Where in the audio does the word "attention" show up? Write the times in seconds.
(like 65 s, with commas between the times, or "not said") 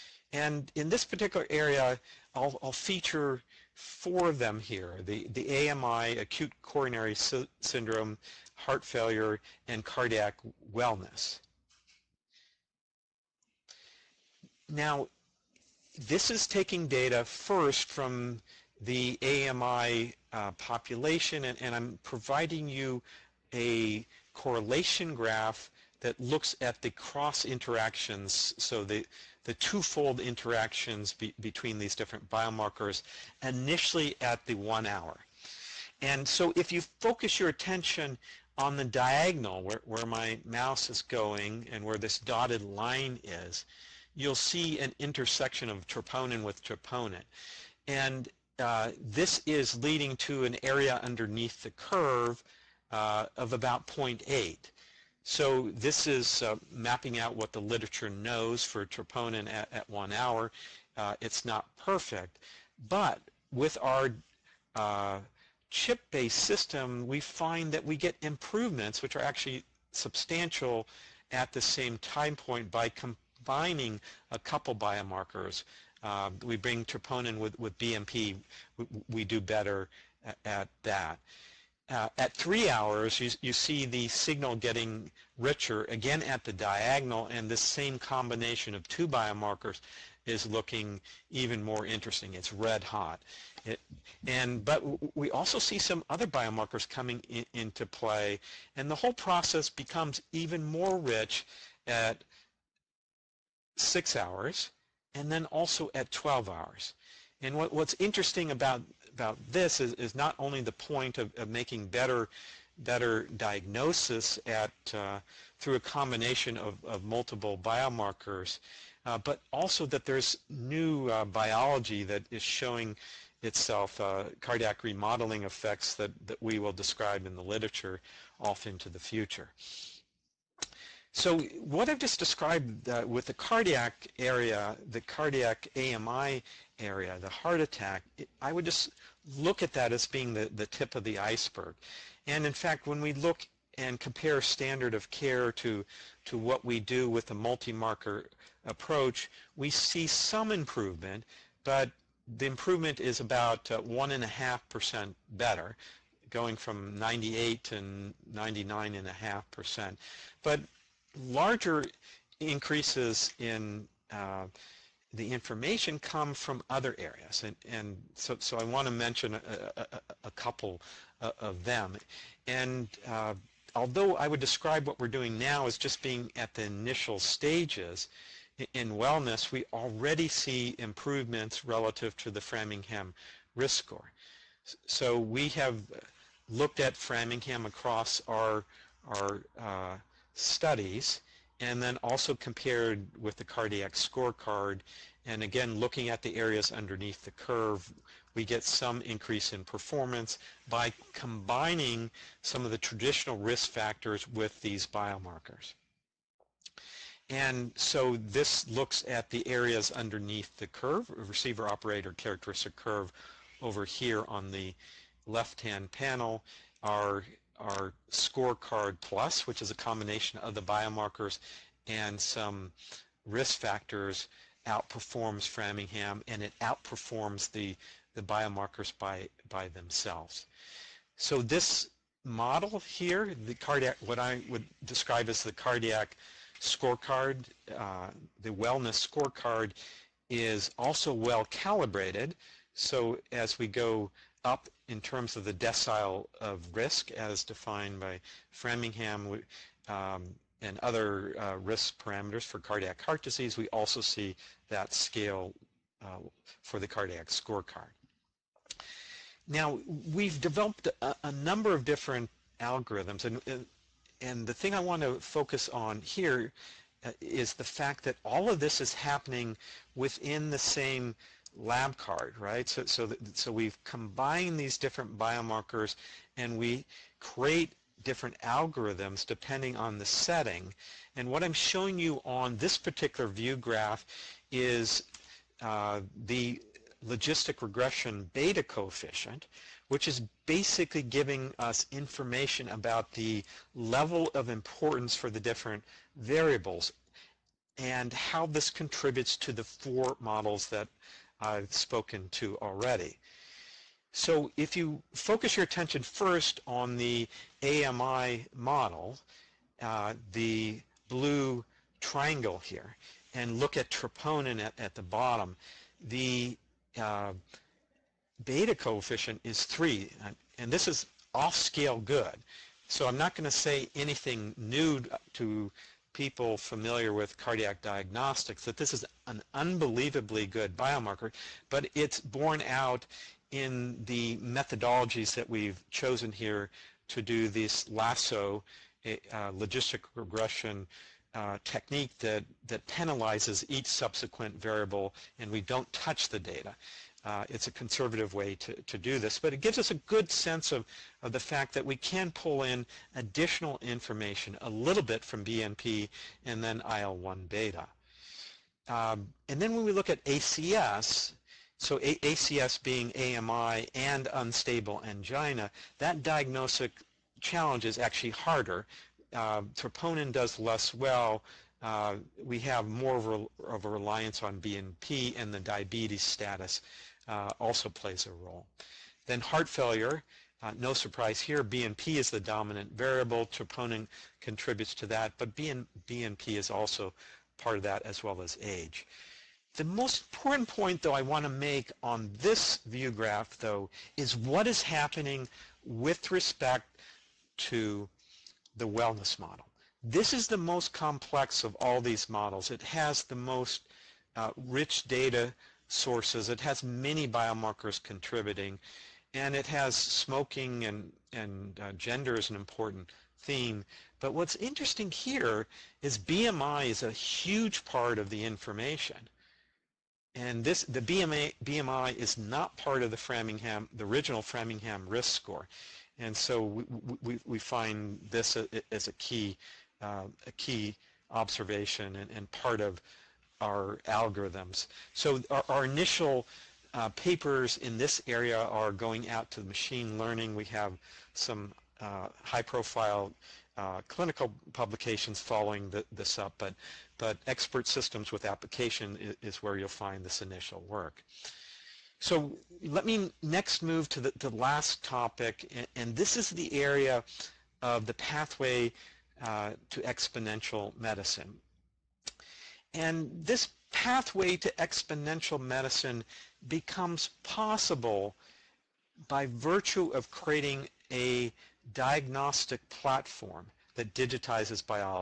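37 s, 305 s.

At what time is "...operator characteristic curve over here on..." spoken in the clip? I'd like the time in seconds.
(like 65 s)
211 s.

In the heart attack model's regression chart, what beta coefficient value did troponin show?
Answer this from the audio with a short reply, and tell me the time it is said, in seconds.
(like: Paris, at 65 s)
3, at 319 s.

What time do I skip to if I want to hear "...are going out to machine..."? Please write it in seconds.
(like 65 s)
438 s.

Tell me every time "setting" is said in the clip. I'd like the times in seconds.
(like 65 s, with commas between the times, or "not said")
280 s.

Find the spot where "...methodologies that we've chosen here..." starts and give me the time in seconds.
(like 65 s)
334 s.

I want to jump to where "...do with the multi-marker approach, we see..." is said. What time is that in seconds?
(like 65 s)
146 s.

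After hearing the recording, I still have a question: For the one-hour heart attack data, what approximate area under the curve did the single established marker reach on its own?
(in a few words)
0.8.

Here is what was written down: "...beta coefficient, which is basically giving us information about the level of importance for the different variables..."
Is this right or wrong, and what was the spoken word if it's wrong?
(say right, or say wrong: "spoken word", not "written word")
right.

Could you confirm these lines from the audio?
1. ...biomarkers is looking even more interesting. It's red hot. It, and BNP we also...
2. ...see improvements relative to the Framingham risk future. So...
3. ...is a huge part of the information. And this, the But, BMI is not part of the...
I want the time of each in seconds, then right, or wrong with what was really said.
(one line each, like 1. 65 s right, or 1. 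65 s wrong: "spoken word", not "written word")
1. 89 s wrong: "But", not "BNP"
2. 180 s wrong: "score", not "future"
3. 416 s wrong: "BMI", not "But".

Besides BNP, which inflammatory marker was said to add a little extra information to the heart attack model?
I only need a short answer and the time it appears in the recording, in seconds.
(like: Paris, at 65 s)
IL-1 beta, at 356 s.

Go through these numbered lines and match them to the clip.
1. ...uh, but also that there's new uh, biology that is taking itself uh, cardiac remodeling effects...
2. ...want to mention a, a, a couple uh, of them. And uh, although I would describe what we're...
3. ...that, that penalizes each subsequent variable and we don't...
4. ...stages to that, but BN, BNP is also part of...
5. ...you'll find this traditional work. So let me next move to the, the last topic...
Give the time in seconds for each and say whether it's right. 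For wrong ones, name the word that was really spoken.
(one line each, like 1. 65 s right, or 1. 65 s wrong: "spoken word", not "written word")
1. 119 s wrong: "showing", not "taking"
2. 168 s right
3. 342 s right
4. 384 s wrong: "contributes", not "stages"
5. 449 s wrong: "initial", not "traditional".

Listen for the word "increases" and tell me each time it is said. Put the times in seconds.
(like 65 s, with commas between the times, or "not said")
162 s, 199 s.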